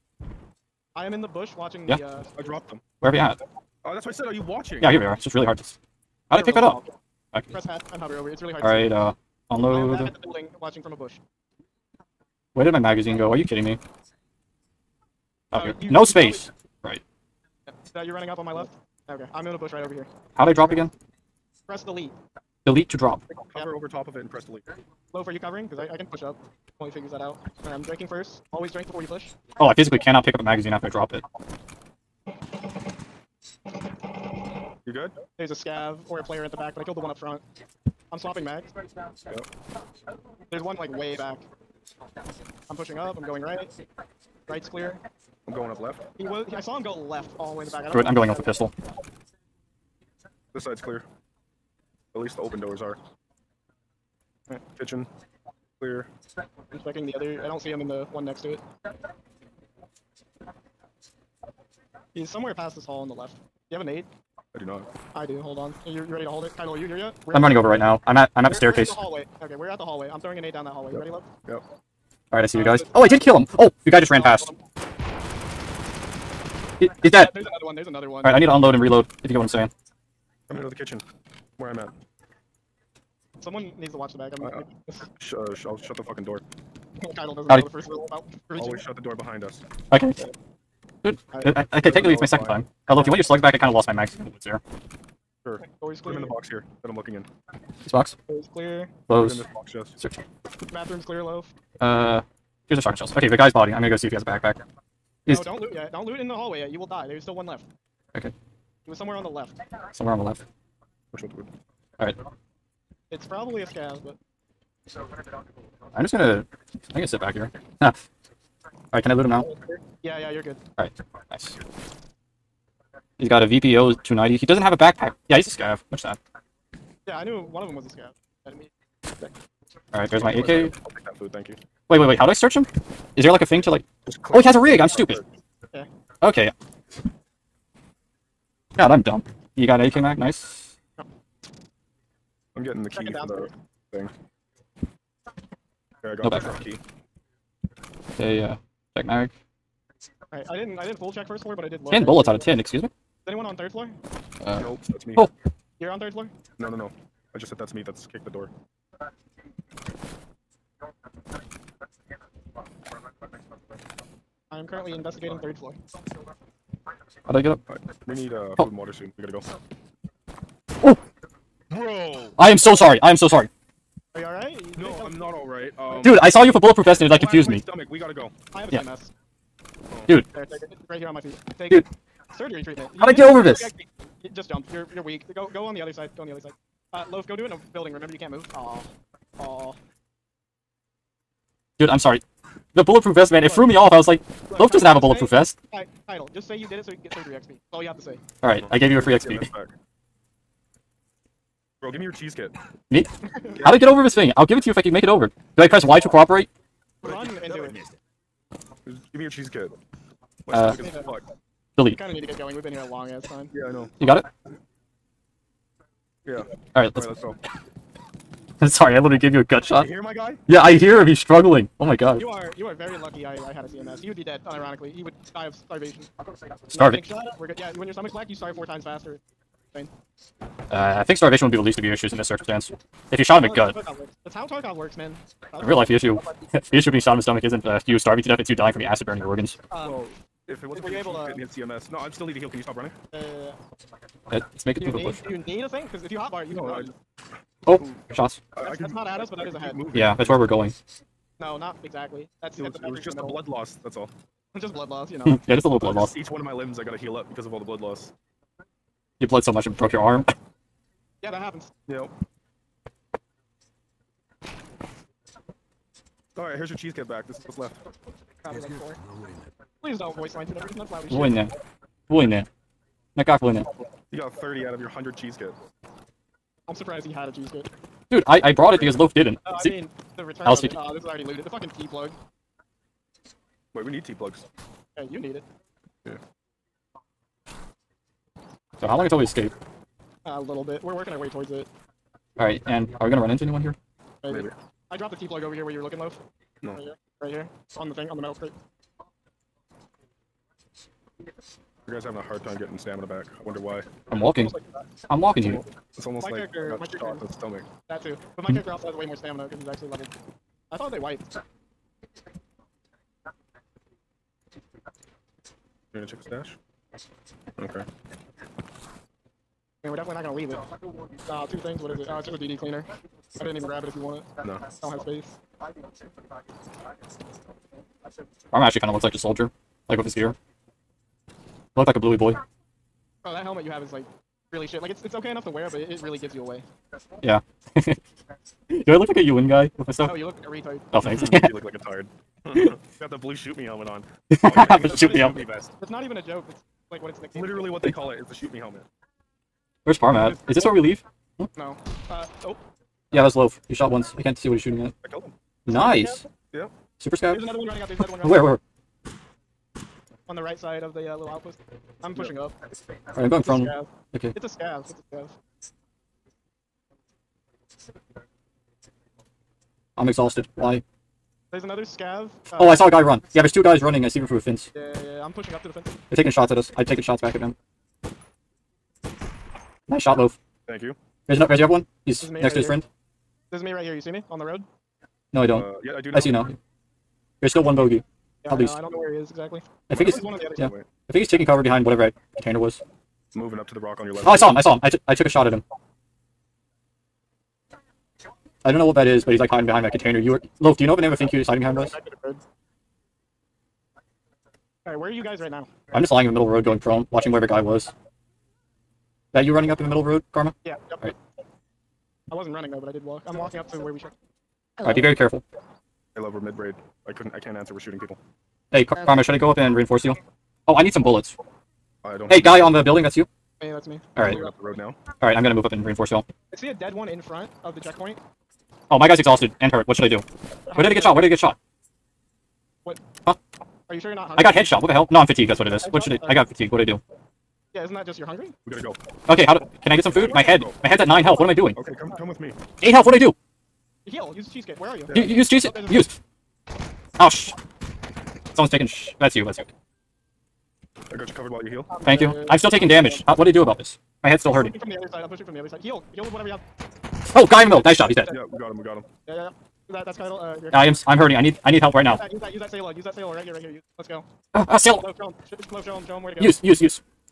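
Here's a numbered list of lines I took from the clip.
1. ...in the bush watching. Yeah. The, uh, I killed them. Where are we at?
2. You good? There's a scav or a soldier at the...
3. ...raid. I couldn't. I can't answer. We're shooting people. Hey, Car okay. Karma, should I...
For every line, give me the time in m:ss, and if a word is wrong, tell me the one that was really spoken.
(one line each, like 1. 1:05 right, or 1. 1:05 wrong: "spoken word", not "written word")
1. 0:01 wrong: "dropped", not "killed"
2. 0:34 wrong: "player", not "soldier"
3. 6:56 right.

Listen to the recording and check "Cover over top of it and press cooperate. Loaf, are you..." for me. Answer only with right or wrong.
wrong.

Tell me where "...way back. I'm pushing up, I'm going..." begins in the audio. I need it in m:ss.
0:40.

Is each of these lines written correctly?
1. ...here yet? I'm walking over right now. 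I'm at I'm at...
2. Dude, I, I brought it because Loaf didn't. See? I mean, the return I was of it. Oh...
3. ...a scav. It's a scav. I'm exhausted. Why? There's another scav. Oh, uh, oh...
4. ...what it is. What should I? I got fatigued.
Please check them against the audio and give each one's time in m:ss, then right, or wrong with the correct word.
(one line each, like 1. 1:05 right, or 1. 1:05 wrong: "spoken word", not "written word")
1. 1:06 wrong: "running", not "walking"
2. 4:38 right
3. 6:04 right
4. 7:15 right.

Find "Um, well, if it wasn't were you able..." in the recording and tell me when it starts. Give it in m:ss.
3:59.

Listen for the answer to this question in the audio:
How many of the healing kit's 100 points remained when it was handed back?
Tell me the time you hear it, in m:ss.
4:34.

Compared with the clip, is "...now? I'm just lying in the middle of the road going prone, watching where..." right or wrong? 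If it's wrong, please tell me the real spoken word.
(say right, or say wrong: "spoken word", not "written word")
right.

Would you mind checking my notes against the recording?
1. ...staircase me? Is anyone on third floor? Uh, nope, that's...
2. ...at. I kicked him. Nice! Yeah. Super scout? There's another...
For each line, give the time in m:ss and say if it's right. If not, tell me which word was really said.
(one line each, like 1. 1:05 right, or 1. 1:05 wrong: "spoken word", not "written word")
1. 2:32 wrong: "excuse", not "staircase"
2. 5:54 wrong: "killed", not "kicked".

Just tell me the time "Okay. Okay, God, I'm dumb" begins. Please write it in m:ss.
2:15.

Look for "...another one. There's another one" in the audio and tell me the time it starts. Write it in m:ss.
1:17.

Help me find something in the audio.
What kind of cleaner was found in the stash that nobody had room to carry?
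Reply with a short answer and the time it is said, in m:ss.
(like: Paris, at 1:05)
DD cleaner, at 5:22.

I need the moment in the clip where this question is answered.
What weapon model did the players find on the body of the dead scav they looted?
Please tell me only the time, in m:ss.
2:03.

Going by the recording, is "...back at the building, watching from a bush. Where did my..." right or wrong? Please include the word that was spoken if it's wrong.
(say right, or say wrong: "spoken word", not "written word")
right.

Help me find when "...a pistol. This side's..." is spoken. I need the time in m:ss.
0:48.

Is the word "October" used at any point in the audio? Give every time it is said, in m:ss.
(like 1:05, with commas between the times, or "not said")
not said.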